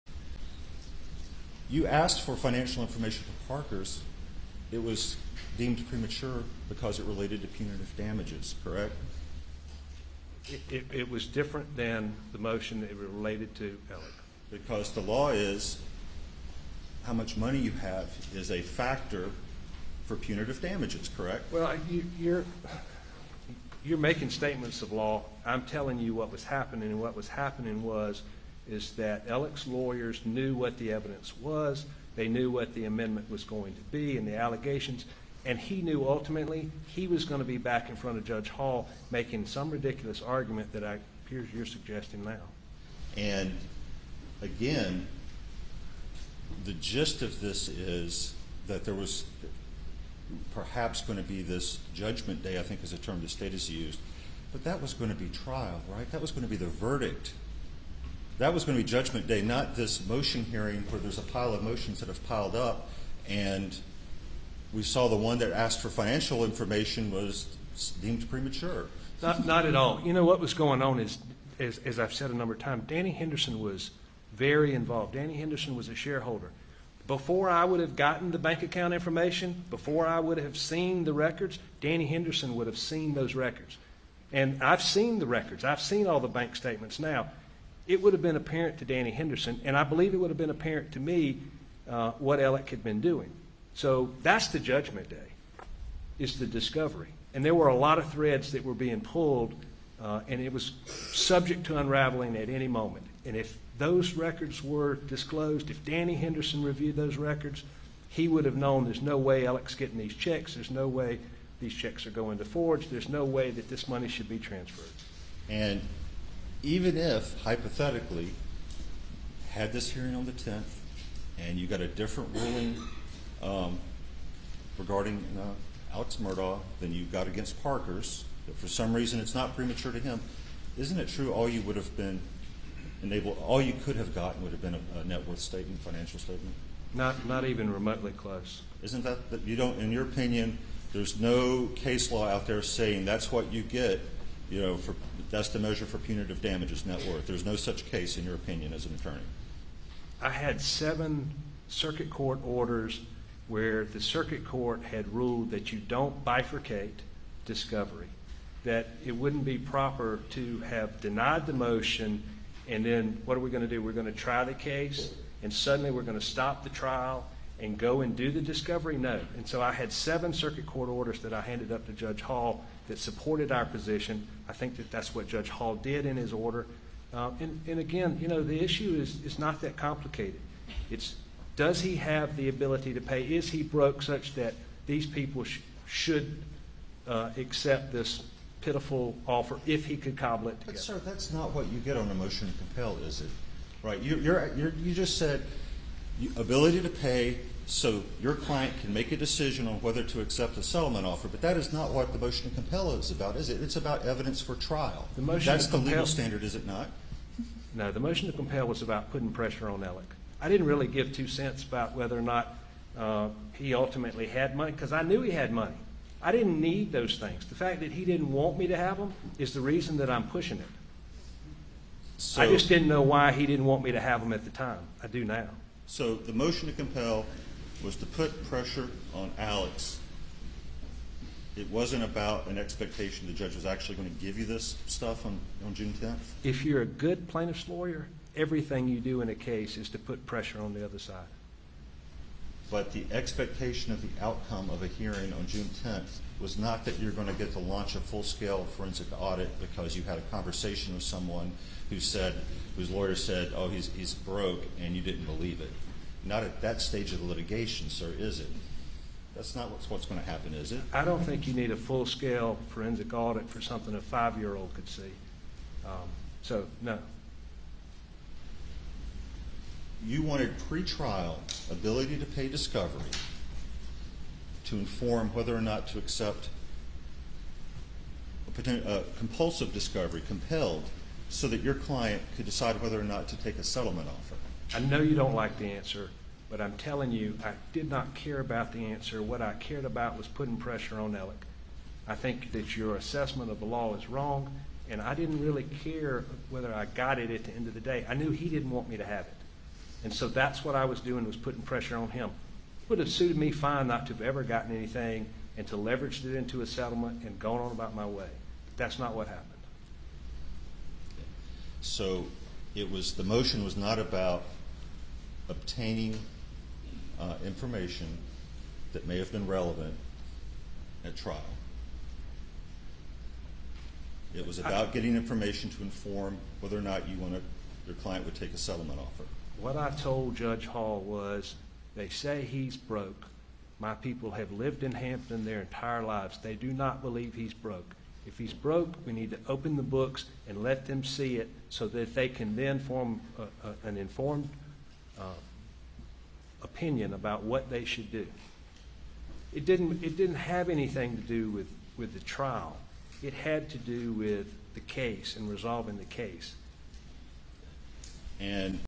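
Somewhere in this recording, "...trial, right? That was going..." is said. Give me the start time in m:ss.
0:55.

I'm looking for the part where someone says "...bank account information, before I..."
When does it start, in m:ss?
1:18.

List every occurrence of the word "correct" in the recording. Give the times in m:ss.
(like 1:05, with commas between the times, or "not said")
0:08, 0:21.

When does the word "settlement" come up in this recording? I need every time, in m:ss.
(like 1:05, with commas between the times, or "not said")
3:20, 4:43, 5:06, 5:28.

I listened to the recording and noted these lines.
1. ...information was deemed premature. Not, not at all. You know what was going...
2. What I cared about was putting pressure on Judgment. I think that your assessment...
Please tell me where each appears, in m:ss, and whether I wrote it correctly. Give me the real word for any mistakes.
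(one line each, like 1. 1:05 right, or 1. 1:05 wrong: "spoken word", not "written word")
1. 1:06 right
2. 4:49 wrong: "Alex", not "Judgment".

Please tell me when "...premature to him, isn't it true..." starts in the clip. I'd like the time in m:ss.
2:09.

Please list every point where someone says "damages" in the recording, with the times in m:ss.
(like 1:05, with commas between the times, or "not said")
0:07, 0:20, 2:26.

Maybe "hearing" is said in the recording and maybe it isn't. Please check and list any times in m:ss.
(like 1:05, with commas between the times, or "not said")
1:00, 1:59, 4:04.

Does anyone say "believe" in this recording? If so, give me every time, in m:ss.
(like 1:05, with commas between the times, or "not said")
1:29, 4:15, 5:37.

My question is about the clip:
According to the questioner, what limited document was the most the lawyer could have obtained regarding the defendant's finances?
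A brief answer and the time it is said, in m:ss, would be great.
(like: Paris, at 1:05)
Net worth statement, at 2:15.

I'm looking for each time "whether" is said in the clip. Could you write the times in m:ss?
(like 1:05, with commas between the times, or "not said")
3:19, 3:31, 4:35, 4:42, 4:56, 5:26.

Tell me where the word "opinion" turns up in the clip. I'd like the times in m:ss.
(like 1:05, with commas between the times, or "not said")
2:20, 2:28, 5:46.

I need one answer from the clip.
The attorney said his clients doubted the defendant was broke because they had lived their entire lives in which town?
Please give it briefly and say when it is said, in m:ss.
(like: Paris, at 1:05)
Hampton, at 5:34.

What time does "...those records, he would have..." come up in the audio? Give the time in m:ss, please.
1:46.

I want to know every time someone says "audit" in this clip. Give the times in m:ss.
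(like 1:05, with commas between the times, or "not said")
4:09, 4:23.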